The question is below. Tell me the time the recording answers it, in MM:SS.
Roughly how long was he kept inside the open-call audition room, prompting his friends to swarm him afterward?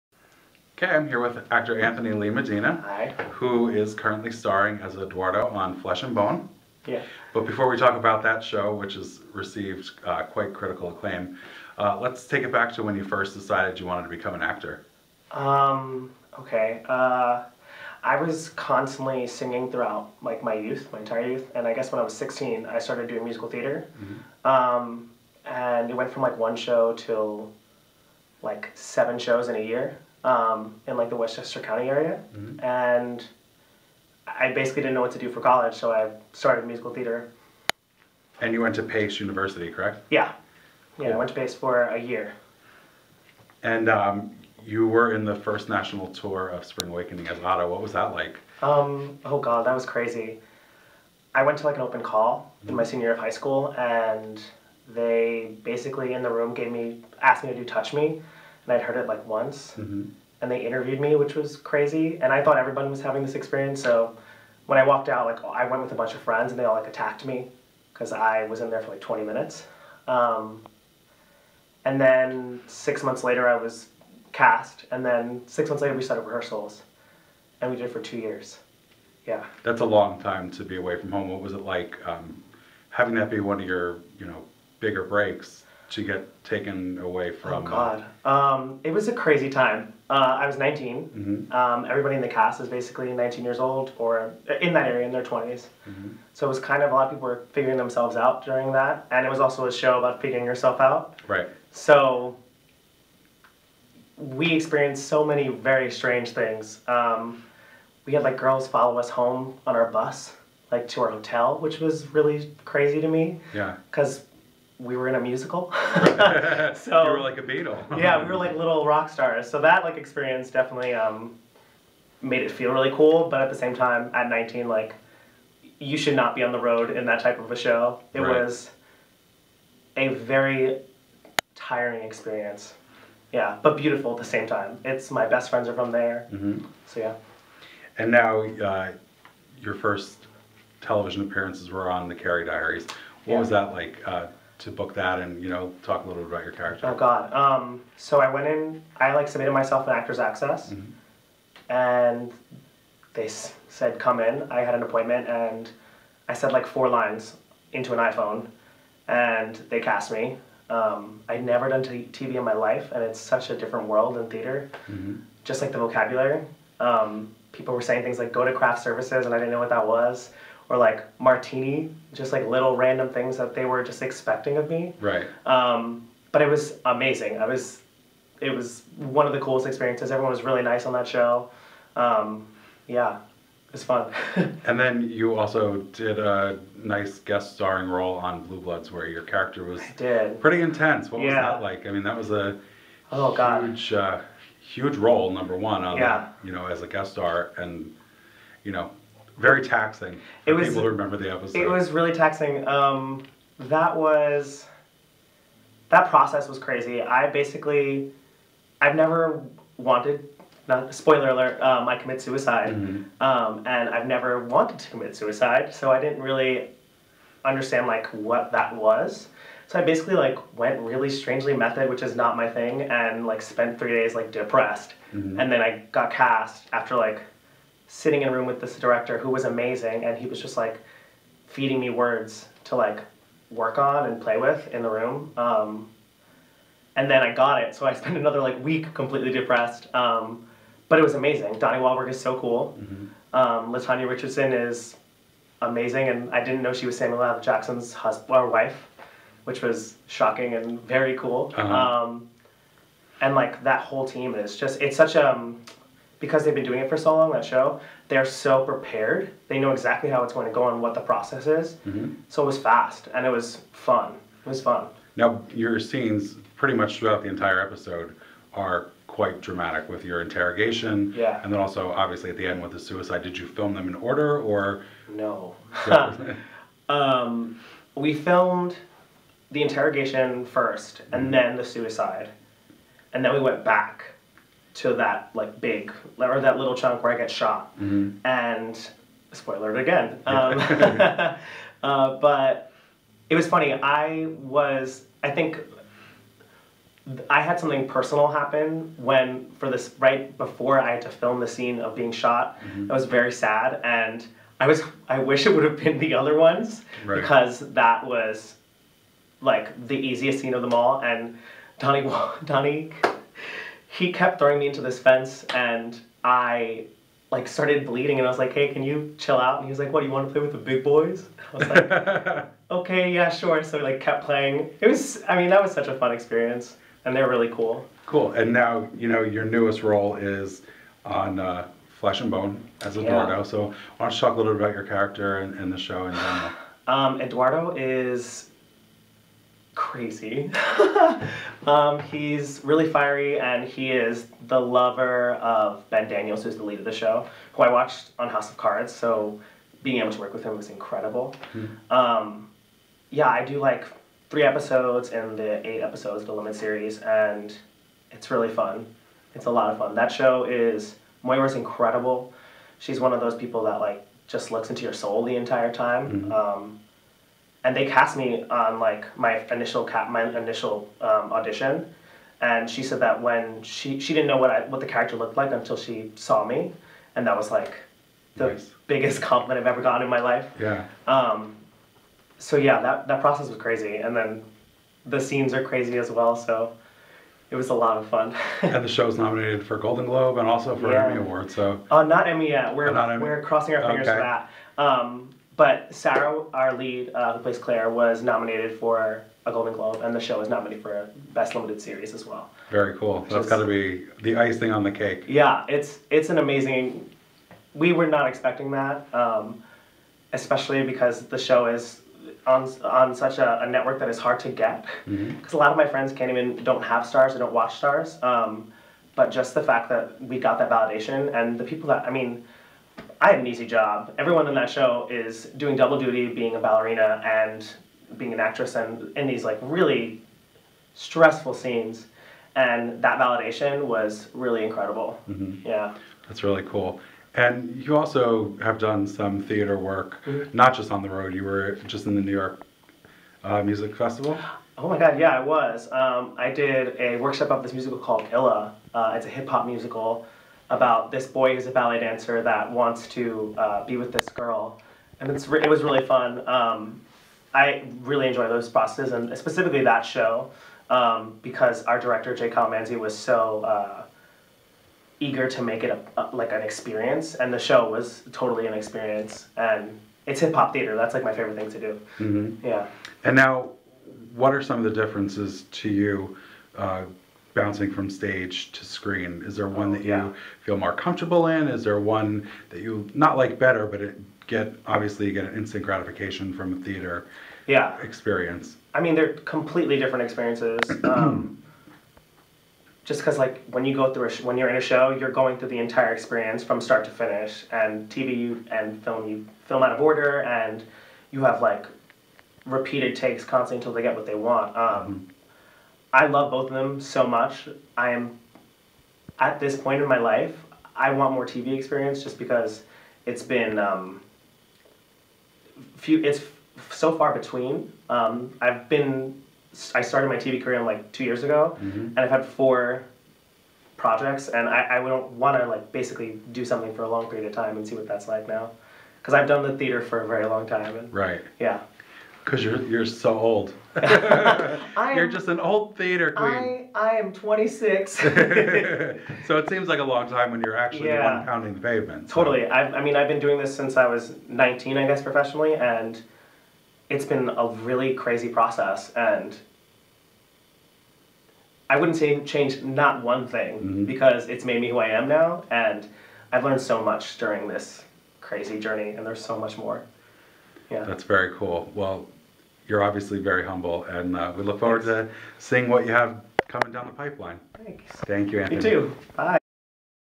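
01:09.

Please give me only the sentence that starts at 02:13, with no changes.
Yeah, but beautiful at the same time.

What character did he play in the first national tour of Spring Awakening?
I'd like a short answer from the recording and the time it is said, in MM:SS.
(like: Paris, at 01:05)
Otto, at 00:47.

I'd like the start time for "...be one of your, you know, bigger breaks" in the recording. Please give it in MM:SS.
01:23.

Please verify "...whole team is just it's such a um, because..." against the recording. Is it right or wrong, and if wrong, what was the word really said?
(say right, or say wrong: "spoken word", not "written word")
right.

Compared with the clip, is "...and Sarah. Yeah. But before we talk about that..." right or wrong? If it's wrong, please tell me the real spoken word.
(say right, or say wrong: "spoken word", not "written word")
wrong: "Bone", not "Sarah".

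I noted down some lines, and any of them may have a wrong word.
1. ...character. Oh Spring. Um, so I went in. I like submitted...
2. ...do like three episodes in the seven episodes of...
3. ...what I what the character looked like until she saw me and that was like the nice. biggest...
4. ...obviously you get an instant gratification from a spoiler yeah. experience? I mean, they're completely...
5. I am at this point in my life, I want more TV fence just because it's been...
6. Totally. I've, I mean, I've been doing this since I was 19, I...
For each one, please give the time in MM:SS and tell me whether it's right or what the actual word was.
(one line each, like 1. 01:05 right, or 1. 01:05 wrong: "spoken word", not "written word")
1. 02:26 wrong: "God", not "Spring"
2. 05:53 wrong: "eight", not "seven"
3. 06:14 right
4. 08:04 wrong: "theater", not "spoiler"
5. 08:27 wrong: "experience", not "fence"
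6. 09:02 right.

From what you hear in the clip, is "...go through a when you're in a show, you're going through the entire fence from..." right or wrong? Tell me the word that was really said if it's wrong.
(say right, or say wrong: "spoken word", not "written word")
wrong: "experience", not "fence".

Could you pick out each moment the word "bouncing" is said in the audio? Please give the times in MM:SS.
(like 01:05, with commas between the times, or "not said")
07:57.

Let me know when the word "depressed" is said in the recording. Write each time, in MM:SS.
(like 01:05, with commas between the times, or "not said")
03:44, 03:59.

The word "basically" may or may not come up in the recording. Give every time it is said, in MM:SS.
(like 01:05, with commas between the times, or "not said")
00:34, 00:55, 01:32, 03:27, 03:39, 08:45.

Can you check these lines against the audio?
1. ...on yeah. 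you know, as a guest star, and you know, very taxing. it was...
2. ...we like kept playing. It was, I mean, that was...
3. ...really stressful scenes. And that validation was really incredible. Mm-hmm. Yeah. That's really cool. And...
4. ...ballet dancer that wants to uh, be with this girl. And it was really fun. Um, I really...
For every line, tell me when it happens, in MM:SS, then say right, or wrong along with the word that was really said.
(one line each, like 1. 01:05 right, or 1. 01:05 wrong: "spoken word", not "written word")
1. 03:15 right
2. 05:23 right
3. 07:09 right
4. 07:31 right.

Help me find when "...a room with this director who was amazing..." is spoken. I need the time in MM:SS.
03:48.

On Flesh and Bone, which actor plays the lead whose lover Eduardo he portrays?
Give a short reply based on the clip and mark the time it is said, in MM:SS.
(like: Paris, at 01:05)
Ben Daniels, at 05:45.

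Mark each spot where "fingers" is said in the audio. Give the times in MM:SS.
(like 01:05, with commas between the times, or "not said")
06:33.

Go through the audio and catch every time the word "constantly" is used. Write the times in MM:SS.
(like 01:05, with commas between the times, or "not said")
00:18, 08:23.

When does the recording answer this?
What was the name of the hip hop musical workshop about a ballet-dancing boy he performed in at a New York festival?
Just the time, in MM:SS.
07:28.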